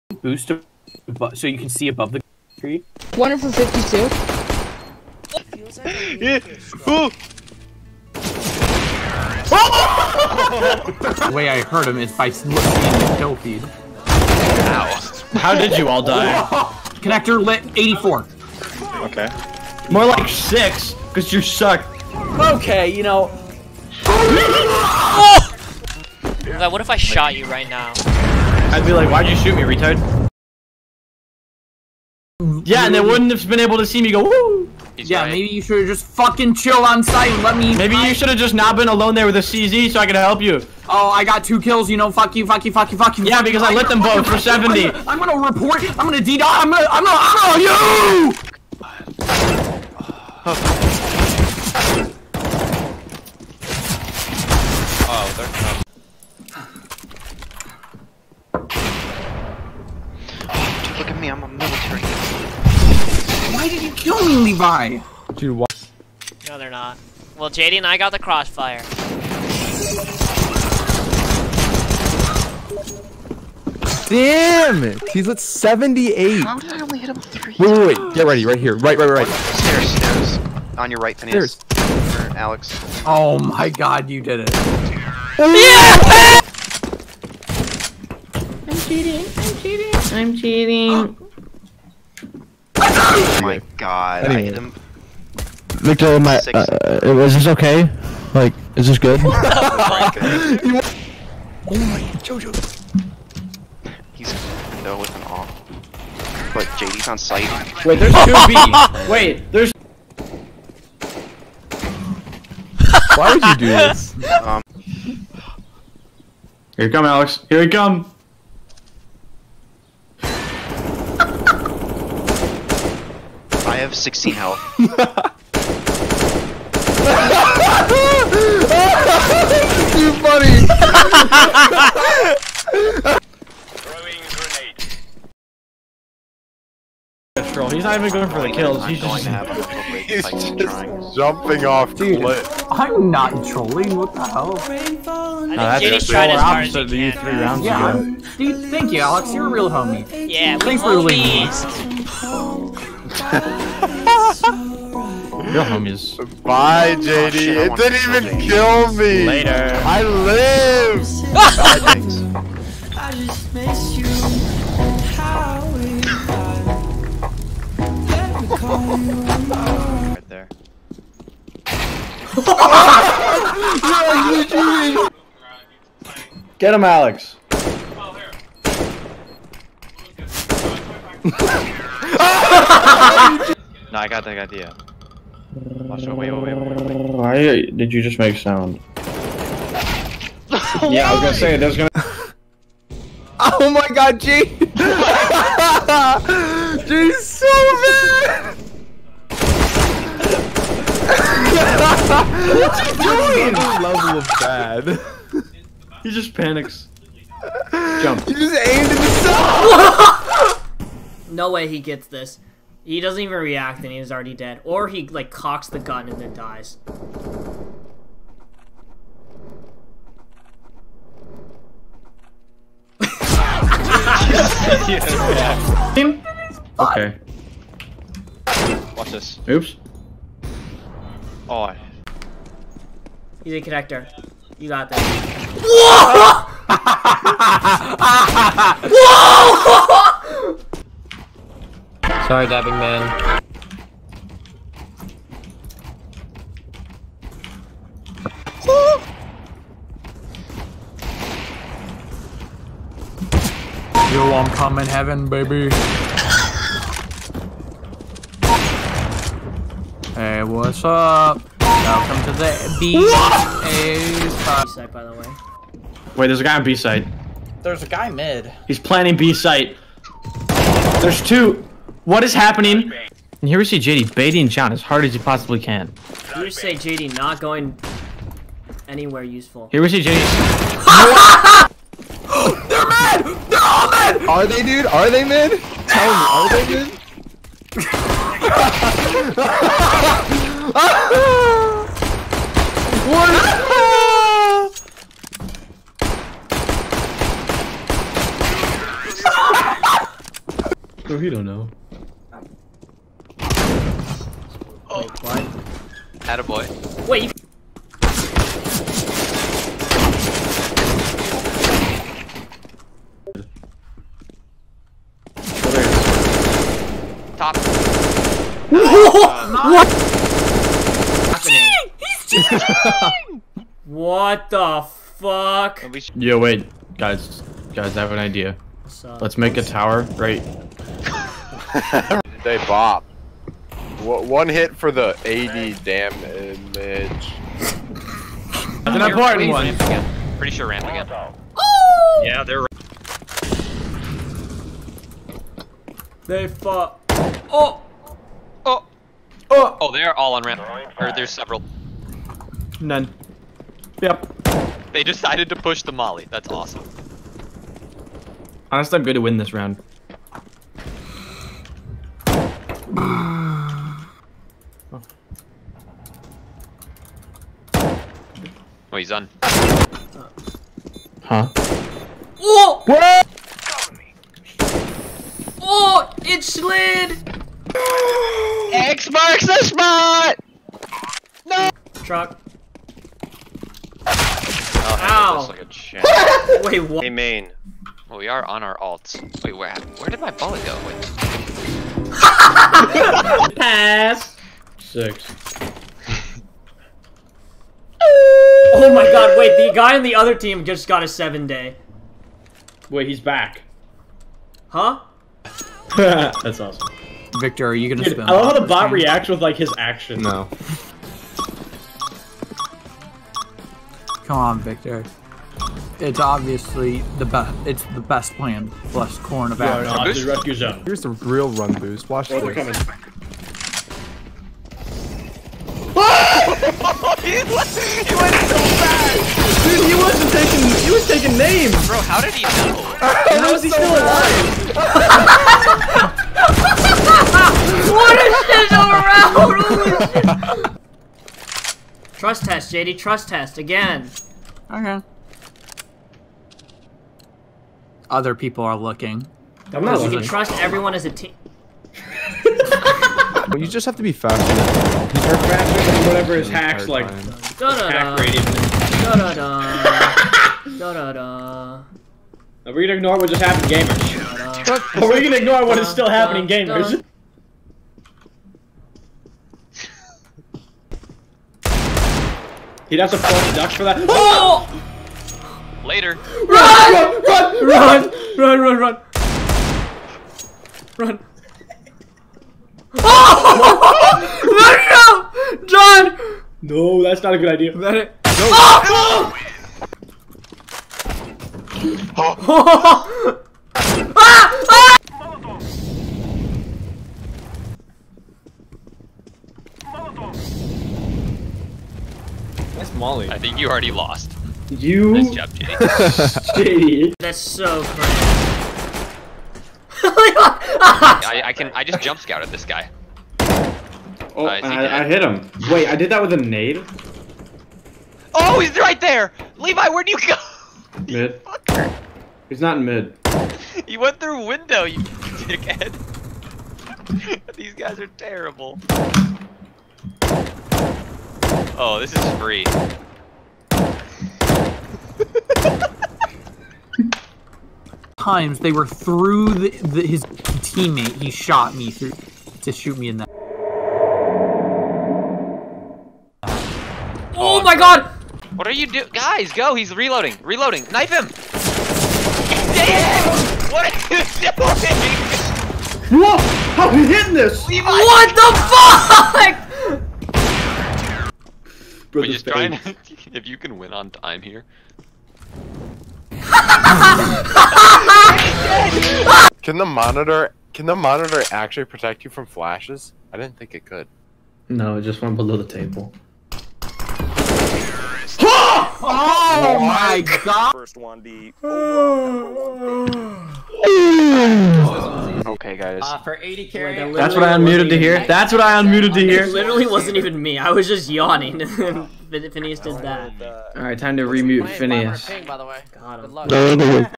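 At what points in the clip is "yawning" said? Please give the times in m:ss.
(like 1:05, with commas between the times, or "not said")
9:51.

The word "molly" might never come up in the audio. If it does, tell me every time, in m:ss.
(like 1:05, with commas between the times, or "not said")
5:55, 8:22.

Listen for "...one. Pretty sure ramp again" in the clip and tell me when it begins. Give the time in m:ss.
5:39.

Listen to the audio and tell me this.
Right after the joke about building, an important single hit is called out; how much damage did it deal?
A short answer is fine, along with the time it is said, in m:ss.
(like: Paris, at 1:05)
80, at 5:34.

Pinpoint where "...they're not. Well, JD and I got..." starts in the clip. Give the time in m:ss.
1:06.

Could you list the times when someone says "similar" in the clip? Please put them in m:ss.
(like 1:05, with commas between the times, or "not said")
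not said.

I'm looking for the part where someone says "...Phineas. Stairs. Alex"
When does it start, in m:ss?
1:21.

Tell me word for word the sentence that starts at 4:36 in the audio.
You say JD not going anywhere useful.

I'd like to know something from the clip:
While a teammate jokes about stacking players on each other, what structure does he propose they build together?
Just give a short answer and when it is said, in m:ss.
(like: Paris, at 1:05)
a tower, at 5:29.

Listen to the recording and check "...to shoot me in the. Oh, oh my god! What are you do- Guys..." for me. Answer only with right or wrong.
right.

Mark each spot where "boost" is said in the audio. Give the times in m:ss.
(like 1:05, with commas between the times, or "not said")
0:00, 7:01.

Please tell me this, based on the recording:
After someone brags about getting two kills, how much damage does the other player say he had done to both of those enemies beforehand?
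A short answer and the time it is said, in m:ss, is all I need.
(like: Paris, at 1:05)
70, at 0:43.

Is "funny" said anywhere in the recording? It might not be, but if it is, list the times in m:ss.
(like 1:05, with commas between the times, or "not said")
2:10, 8:27.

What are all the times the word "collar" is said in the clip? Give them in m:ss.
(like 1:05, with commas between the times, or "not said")
not said.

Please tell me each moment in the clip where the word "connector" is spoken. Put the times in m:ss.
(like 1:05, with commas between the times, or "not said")
0:17, 3:53.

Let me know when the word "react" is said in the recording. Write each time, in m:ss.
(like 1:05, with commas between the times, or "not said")
3:33, 6:48.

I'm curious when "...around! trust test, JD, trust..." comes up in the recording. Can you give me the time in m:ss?
7:20.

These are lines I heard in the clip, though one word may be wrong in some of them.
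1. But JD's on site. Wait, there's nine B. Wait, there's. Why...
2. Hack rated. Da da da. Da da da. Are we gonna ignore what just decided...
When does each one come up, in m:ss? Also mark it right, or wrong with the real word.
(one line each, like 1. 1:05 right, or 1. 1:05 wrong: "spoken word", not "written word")
1. 1:46 wrong: "two", not "nine"
2. 7:37 wrong: "happened", not "decided".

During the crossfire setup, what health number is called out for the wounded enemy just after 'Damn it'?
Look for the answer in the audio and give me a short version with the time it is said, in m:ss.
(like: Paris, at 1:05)
78, at 1:15.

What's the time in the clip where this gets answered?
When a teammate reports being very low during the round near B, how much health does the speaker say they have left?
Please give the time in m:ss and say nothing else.
2:03.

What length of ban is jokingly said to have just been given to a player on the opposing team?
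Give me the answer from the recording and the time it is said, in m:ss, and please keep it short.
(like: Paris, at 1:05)
seven day, at 6:41.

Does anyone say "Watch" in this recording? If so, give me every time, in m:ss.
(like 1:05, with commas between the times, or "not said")
3:05, 3:48, 7:02.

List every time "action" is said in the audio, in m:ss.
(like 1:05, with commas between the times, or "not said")
6:49, 6:59.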